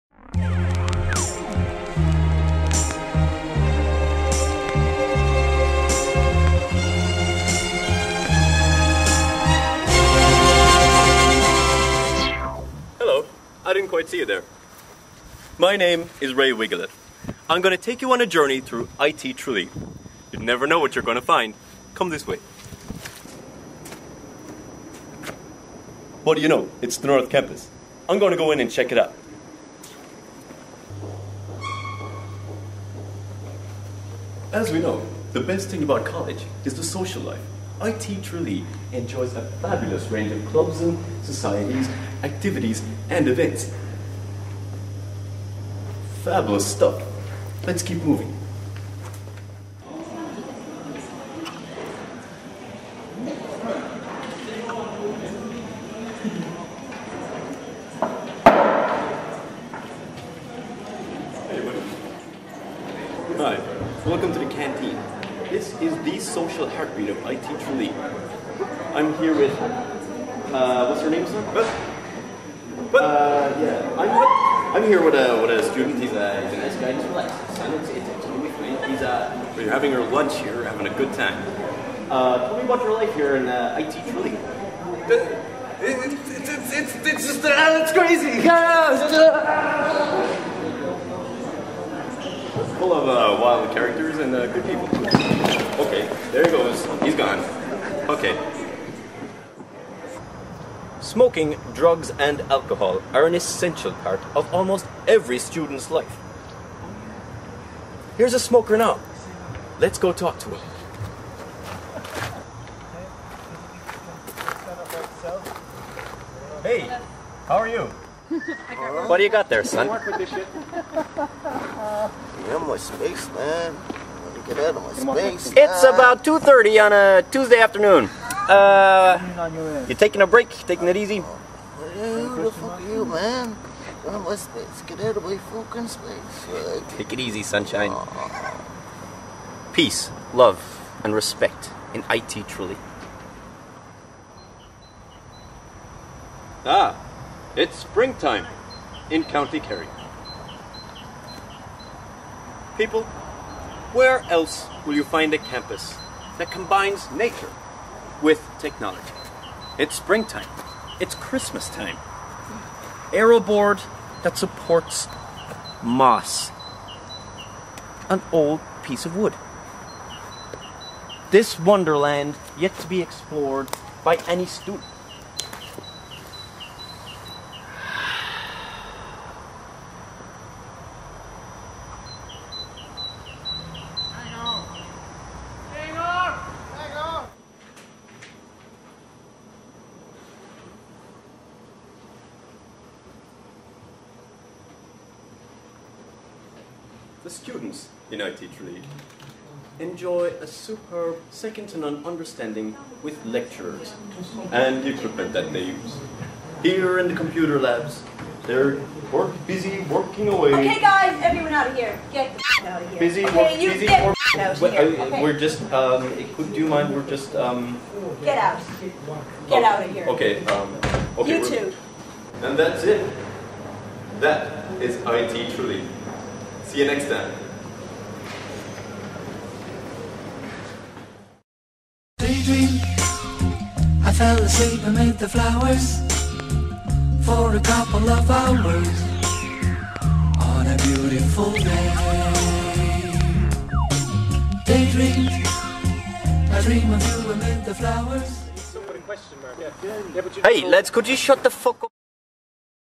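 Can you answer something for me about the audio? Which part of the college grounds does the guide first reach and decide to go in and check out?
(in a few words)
North Campus.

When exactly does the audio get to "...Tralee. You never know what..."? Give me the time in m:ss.
0:19.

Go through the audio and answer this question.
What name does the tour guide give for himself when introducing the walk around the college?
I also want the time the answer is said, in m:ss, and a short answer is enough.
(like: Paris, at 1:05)
Ray Wigglet, at 0:16.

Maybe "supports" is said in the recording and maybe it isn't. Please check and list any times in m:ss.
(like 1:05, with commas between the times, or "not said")
2:44.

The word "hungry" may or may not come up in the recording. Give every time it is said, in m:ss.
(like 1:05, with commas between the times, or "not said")
not said.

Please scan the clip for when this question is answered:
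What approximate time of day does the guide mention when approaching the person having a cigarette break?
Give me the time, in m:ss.
2:06.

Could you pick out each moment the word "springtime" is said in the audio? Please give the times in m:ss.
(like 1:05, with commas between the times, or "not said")
2:27, 2:39.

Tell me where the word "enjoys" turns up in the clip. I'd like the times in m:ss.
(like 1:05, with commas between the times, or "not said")
0:38, 3:19.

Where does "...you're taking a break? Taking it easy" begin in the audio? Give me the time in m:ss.
2:09.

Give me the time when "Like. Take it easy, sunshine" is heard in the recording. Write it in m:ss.
2:16.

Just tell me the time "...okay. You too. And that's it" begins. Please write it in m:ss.
3:41.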